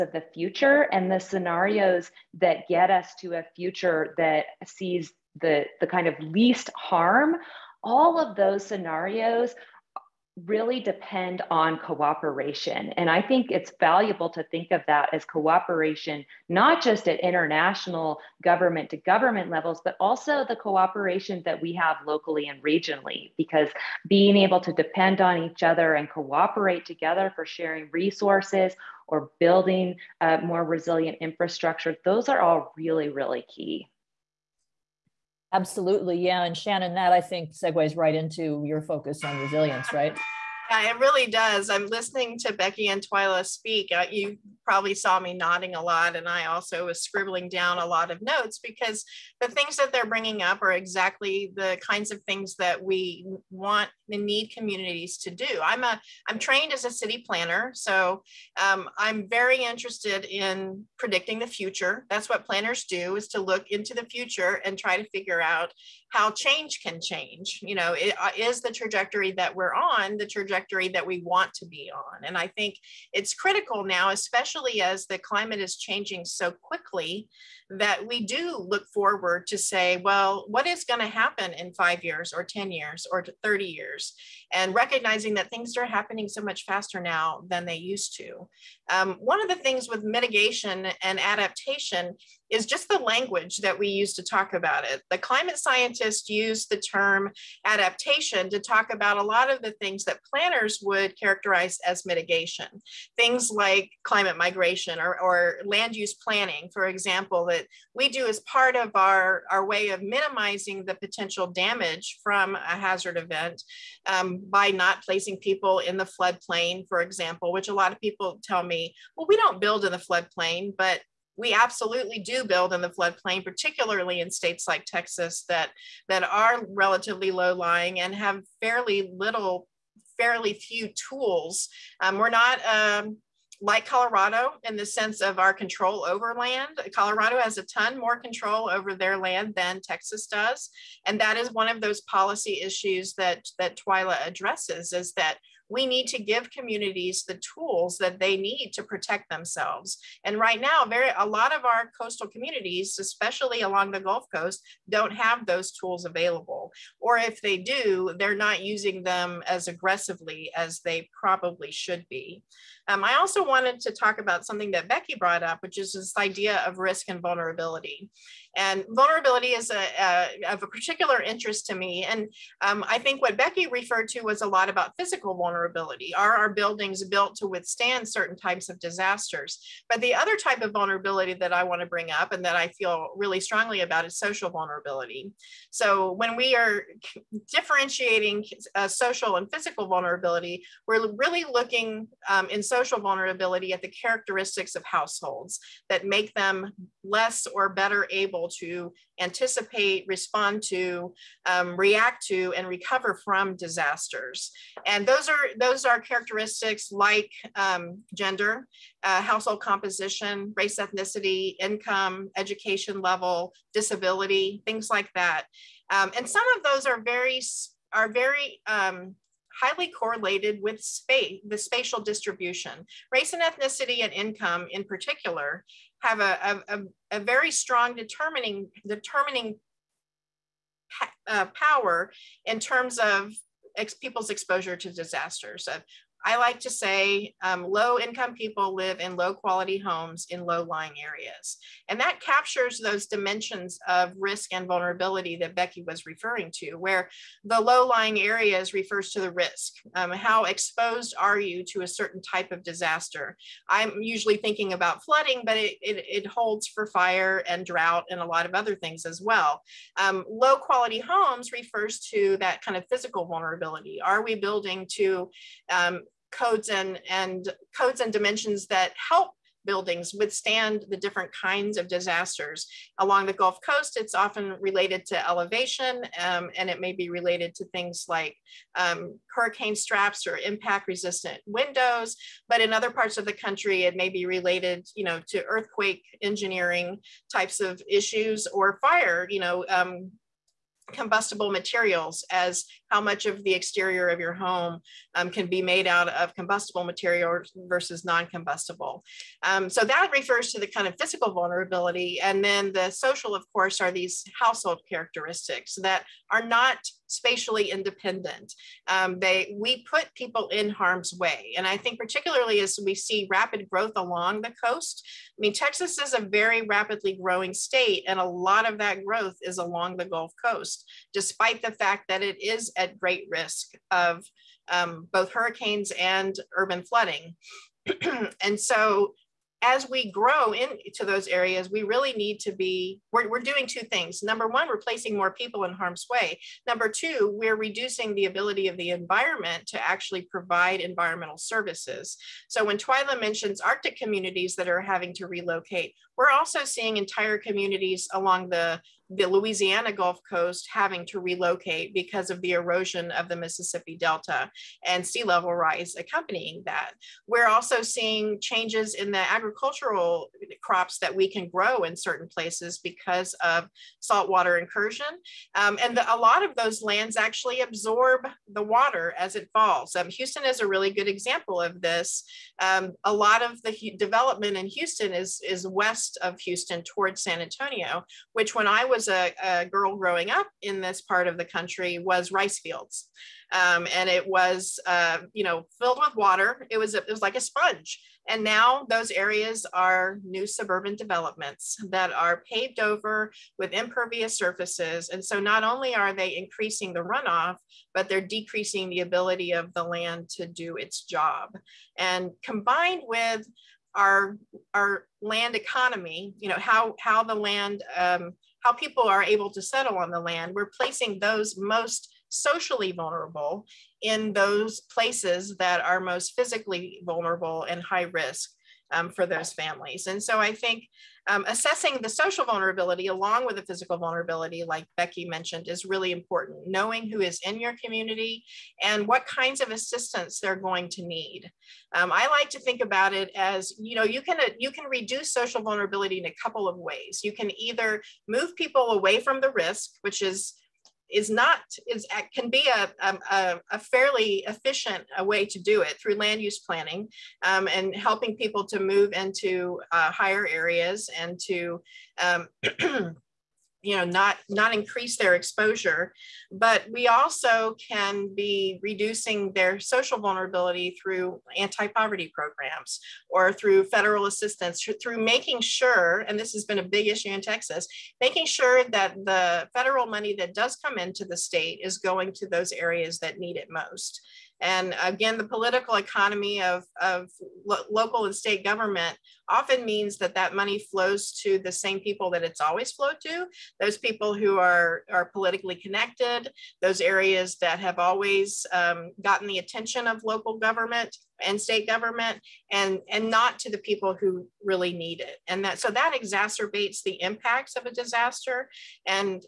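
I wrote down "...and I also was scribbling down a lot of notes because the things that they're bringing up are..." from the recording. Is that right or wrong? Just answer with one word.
right.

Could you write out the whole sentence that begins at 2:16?
Colorado has a ton more control over their land than Texas does.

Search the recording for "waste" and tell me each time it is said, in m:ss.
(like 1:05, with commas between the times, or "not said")
not said.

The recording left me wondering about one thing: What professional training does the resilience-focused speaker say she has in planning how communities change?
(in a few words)
City planner.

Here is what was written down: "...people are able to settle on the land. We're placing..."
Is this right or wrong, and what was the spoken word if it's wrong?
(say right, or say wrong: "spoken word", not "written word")
right.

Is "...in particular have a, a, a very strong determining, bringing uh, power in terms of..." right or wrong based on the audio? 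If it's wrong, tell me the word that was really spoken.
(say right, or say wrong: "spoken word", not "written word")
wrong: "determining", not "bringing".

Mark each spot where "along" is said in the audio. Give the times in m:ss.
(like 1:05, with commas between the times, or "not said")
2:33, 4:33, 5:13, 5:19, 5:48, 7:03.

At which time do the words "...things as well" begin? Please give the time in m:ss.
4:18.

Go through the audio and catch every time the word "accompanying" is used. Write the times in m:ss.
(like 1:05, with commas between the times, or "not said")
5:55.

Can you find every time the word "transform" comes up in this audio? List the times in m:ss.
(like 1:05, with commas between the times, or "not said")
not said.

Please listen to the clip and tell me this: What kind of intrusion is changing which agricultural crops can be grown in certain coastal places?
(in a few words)
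Saltwater incursion.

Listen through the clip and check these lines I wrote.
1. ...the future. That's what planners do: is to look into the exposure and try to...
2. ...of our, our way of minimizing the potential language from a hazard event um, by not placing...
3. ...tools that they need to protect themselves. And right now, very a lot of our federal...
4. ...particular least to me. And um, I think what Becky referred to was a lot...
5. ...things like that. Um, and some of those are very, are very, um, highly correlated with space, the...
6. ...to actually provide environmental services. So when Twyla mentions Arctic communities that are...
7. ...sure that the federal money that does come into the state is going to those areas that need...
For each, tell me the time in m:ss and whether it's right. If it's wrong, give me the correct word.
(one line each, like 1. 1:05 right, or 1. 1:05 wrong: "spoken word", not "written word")
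1. 1:01 wrong: "future", not "exposure"
2. 1:48 wrong: "damage", not "language"
3. 2:27 wrong: "coastal", not "federal"
4. 2:50 wrong: "interest", not "least"
5. 3:34 right
6. 5:39 right
7. 7:48 right.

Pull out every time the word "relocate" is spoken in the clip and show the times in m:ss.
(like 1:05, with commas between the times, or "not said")
5:45, 5:51.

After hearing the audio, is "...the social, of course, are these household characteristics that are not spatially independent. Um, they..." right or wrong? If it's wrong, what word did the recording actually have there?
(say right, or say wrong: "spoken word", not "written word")
right.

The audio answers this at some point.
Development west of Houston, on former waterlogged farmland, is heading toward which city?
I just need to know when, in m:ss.
6:17.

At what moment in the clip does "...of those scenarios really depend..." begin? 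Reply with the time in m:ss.
0:08.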